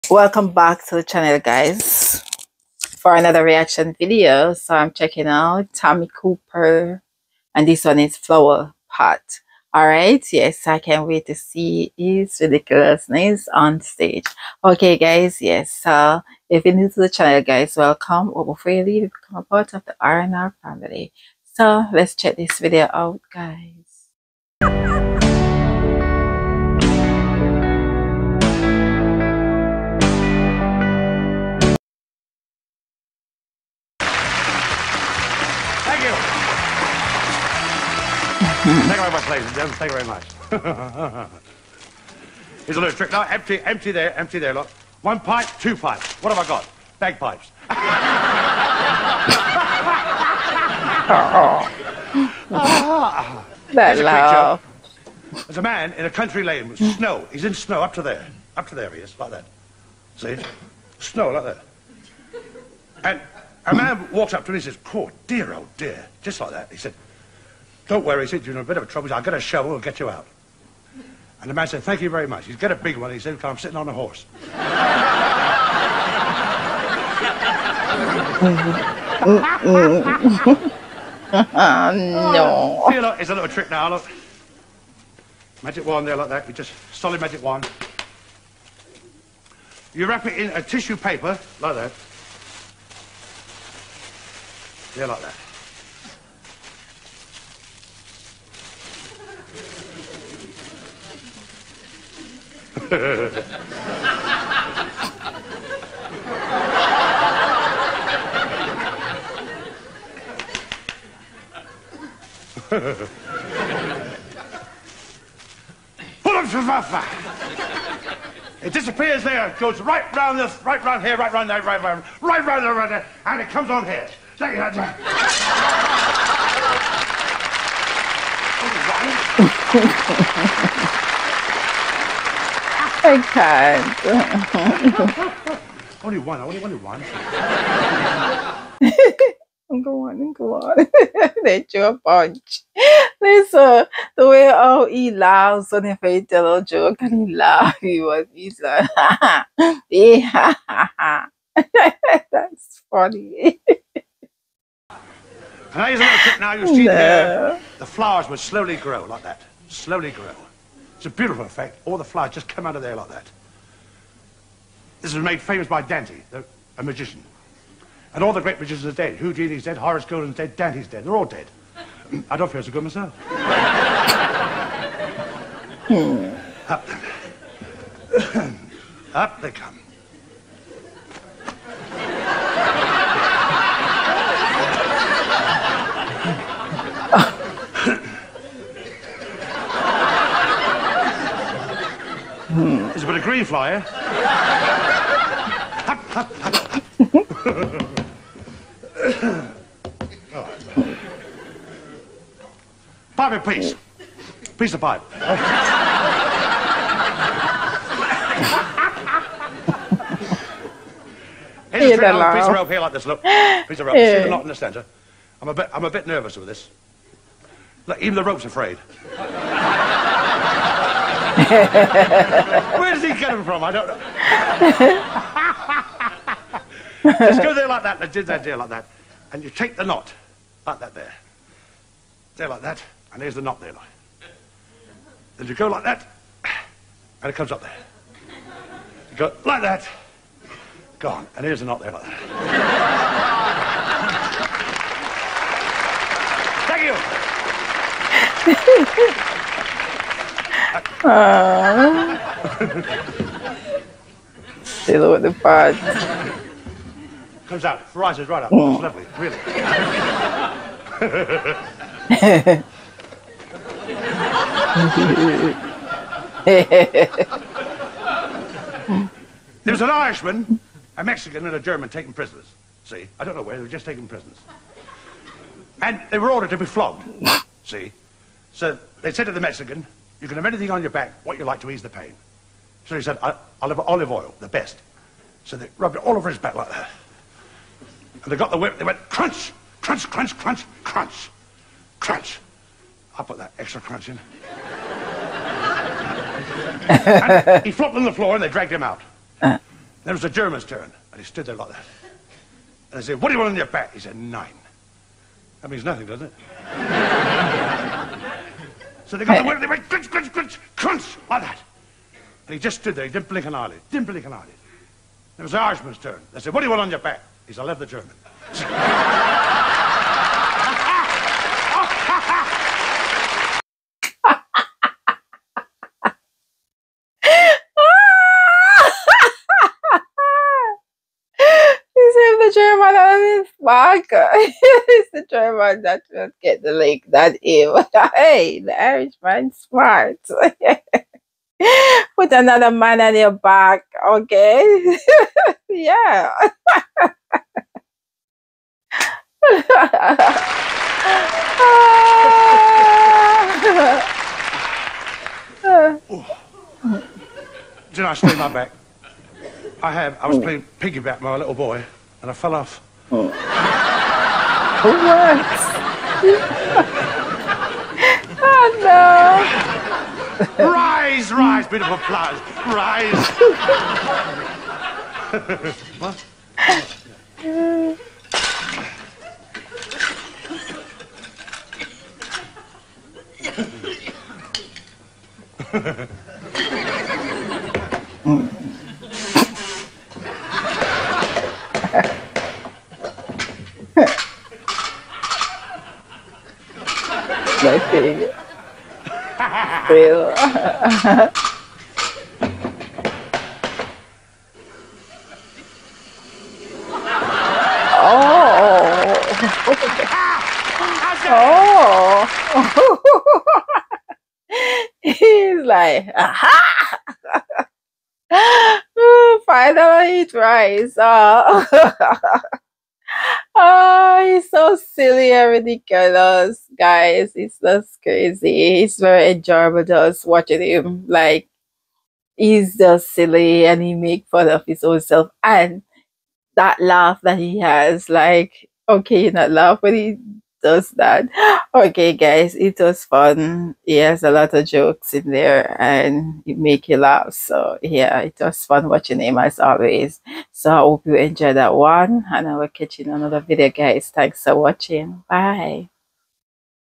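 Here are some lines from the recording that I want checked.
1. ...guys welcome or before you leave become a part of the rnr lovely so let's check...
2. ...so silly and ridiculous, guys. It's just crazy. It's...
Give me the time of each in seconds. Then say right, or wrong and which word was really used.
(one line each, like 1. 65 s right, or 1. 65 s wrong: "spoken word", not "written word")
1. 17 s wrong: "family", not "lovely"
2. 424 s right.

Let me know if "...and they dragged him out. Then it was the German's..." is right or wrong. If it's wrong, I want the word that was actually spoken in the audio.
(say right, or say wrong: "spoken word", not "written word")
right.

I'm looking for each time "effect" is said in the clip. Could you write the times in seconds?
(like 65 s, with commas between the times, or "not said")
161 s.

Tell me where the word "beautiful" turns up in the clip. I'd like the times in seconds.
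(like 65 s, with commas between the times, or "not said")
161 s.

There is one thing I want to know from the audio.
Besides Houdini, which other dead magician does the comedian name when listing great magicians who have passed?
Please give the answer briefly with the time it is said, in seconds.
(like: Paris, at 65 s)
Horace Goldin, at 169 s.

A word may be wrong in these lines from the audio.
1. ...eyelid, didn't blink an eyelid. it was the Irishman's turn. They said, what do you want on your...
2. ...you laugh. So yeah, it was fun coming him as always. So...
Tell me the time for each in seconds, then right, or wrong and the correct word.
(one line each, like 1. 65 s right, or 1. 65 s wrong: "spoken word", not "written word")
1. 313 s right
2. 446 s wrong: "watching", not "coming".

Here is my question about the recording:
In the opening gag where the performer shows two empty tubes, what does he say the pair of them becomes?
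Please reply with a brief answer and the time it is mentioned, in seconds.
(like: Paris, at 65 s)
Bagpipes, at 46 s.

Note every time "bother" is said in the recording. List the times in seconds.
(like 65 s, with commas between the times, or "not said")
not said.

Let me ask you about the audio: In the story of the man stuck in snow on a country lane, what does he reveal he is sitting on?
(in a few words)
A horse.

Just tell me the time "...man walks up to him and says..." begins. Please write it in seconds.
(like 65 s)
63 s.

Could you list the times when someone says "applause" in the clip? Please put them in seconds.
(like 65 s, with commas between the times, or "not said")
371 s.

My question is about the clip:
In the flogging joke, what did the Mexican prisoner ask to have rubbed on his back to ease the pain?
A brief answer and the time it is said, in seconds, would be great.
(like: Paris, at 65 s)
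Olive oil, at 283 s.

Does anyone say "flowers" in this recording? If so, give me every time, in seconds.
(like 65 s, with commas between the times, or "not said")
8 s, 157 s, 162 s.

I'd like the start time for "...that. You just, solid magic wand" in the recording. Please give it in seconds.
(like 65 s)
86 s.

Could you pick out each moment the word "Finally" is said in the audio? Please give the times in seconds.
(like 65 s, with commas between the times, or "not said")
419 s.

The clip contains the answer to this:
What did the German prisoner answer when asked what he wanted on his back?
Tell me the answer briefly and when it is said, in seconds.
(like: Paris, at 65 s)
Nine, at 304 s.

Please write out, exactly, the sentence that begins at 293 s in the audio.
I put that extra crunch in.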